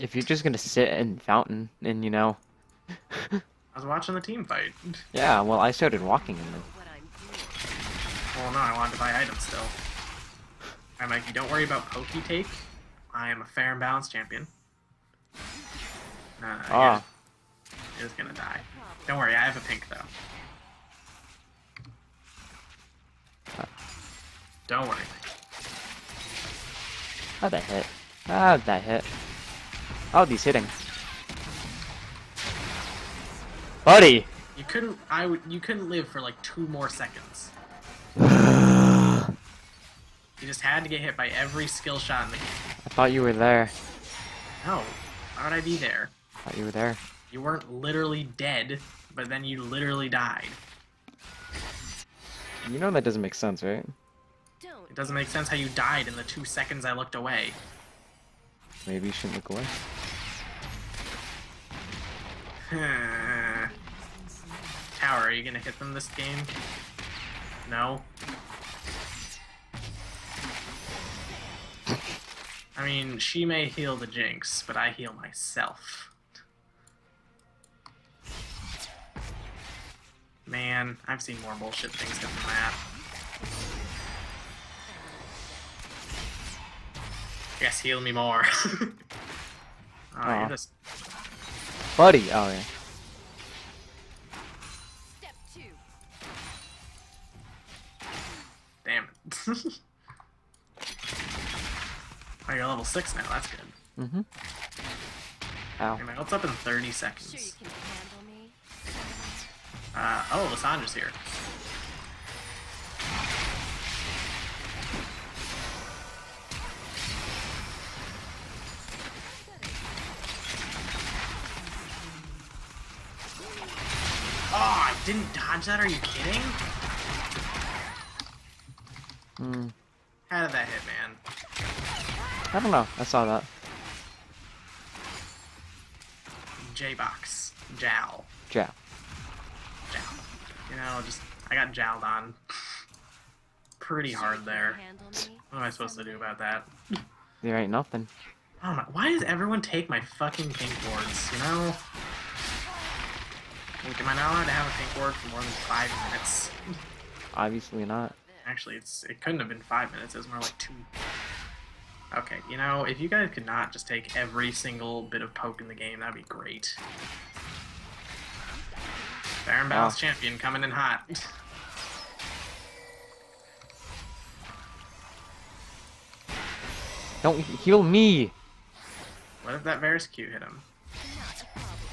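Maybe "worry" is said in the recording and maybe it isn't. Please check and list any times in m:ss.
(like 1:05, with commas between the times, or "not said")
0:11, 0:19, 0:24.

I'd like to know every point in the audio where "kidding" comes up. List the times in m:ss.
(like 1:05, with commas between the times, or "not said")
2:06.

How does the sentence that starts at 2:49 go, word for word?
Baron Battles Champion coming in hot.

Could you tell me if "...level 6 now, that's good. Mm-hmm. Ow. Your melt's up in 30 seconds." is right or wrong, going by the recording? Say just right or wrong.
right.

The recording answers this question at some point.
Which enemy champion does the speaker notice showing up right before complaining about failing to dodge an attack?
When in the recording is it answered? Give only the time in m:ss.
1:50.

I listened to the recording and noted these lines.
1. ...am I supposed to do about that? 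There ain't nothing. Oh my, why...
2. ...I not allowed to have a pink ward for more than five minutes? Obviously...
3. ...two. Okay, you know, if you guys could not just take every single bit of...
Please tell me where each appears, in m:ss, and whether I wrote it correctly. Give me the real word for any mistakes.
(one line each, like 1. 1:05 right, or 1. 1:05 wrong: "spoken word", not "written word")
1. 2:25 right
2. 2:34 right
3. 2:40 right.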